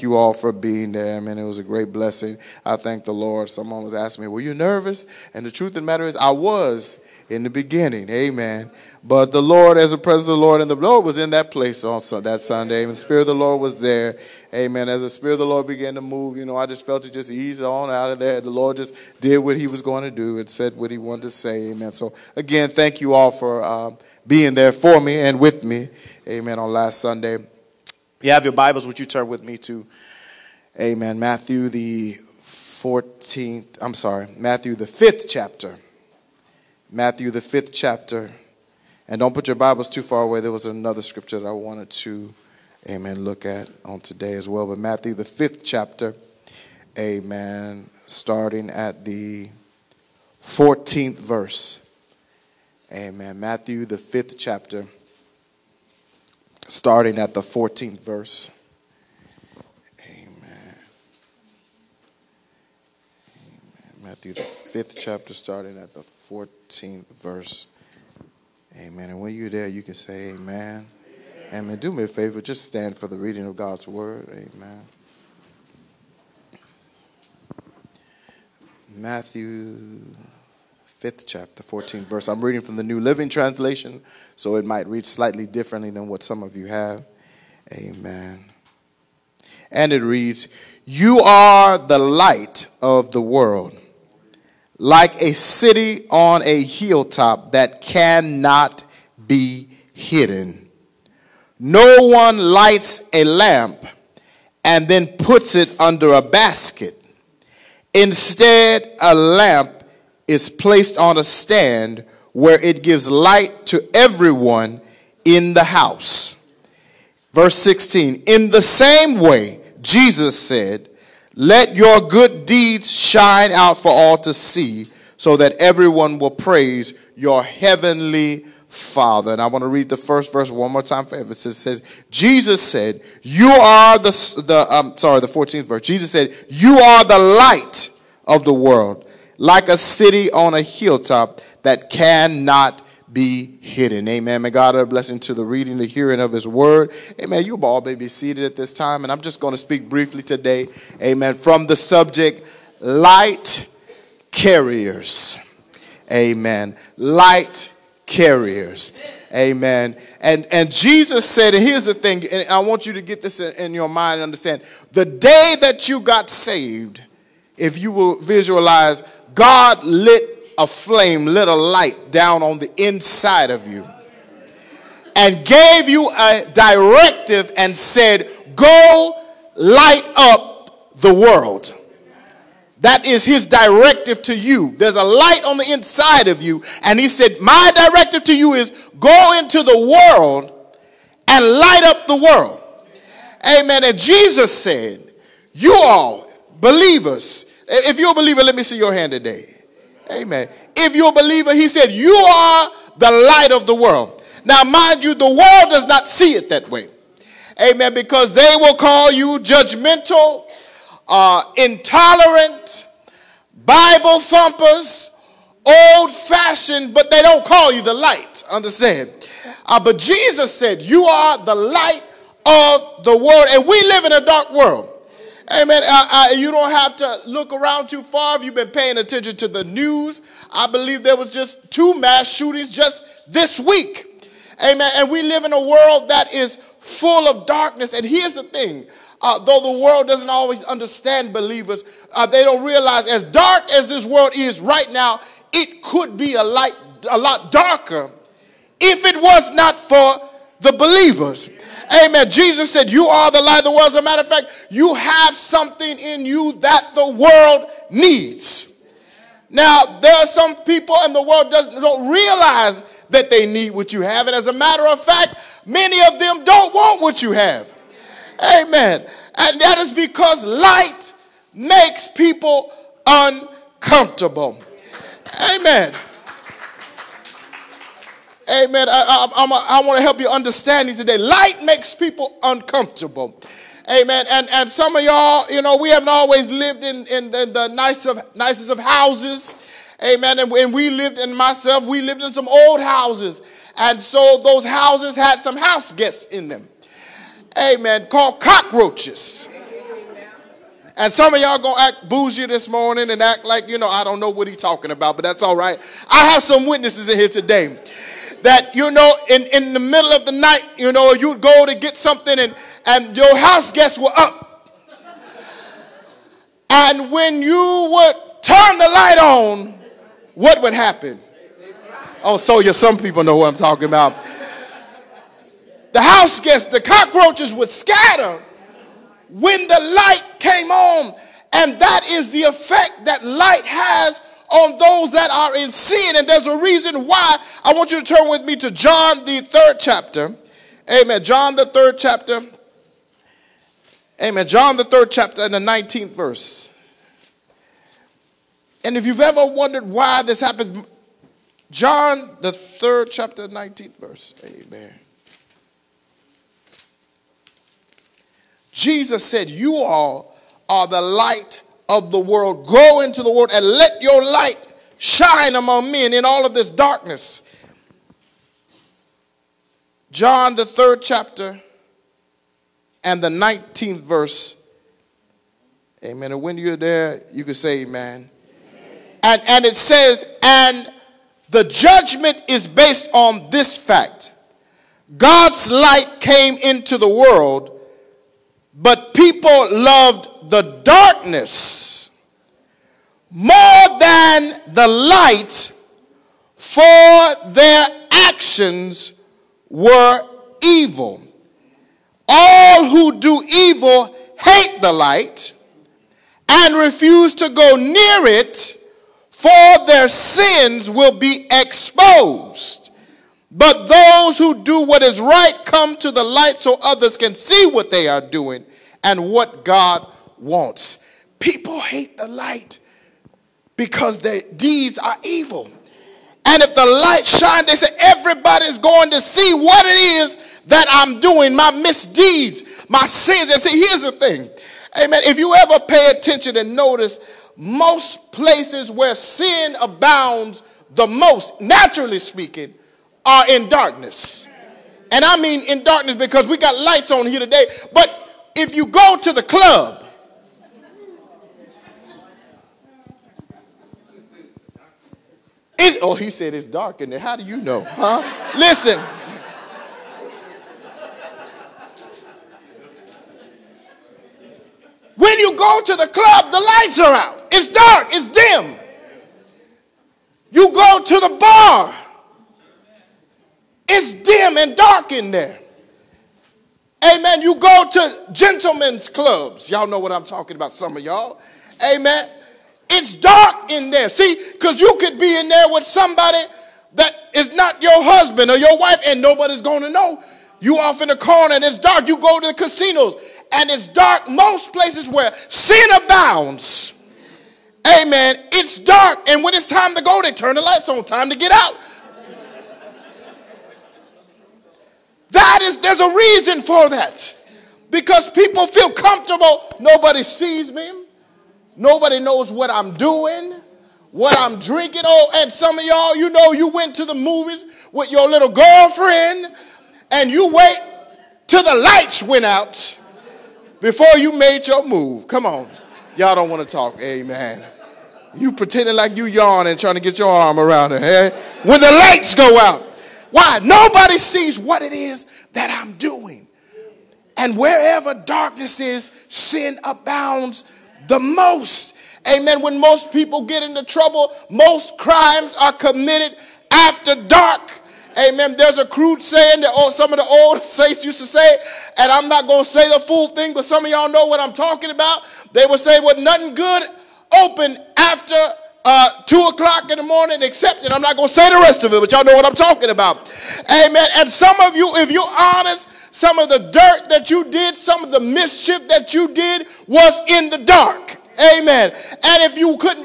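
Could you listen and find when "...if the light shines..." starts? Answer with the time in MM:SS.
07:06.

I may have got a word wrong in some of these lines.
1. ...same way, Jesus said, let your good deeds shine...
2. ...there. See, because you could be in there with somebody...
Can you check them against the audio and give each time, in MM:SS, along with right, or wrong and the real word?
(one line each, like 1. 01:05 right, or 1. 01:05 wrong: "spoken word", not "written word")
1. 01:58 right
2. 08:03 right.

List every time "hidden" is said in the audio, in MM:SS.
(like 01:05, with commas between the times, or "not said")
01:39, 02:23.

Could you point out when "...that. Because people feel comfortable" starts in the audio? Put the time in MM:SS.
08:26.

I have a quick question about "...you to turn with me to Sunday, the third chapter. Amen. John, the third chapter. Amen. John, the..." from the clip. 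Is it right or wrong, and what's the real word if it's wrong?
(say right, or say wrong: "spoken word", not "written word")
wrong: "John", not "Sunday".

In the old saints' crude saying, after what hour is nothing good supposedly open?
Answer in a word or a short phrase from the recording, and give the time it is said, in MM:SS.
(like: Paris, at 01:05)
2 o'clock, at 09:19.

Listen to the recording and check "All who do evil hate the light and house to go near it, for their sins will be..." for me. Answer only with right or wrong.
wrong.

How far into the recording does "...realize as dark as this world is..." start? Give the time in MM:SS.
04:02.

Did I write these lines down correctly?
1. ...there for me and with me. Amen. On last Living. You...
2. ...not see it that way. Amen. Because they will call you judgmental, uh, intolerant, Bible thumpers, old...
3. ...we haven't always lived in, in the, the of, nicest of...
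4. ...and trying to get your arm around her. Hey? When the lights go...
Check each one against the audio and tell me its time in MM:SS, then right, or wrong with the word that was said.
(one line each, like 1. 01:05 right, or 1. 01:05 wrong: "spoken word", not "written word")
1. 00:24 wrong: "Sunday", not "Living"
2. 03:25 right
3. 04:45 right
4. 08:49 right.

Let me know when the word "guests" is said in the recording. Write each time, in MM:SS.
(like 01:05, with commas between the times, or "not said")
04:55, 05:13, 05:26.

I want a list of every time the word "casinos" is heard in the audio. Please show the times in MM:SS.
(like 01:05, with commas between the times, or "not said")
08:12.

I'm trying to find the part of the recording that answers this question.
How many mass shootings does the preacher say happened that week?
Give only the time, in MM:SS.
03:51.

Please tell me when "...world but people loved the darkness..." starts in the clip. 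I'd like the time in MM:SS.
06:27.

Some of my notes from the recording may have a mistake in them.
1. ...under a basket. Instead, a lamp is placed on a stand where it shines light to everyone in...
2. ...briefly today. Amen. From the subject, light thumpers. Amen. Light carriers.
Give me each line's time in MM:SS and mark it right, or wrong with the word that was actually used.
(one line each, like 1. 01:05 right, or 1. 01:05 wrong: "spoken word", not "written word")
1. 01:45 wrong: "gives", not "shines"
2. 02:29 wrong: "carriers", not "thumpers".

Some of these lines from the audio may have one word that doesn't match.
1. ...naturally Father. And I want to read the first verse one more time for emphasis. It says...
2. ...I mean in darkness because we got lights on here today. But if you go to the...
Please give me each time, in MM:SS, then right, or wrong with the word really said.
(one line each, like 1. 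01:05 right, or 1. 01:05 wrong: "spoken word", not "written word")
1. 02:07 wrong: "heavenly", not "naturally"
2. 07:25 right.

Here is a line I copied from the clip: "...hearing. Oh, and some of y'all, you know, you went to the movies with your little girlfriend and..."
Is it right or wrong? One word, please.
wrong.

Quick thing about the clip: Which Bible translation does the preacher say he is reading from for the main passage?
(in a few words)
New Living Translation.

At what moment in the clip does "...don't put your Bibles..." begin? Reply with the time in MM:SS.
00:39.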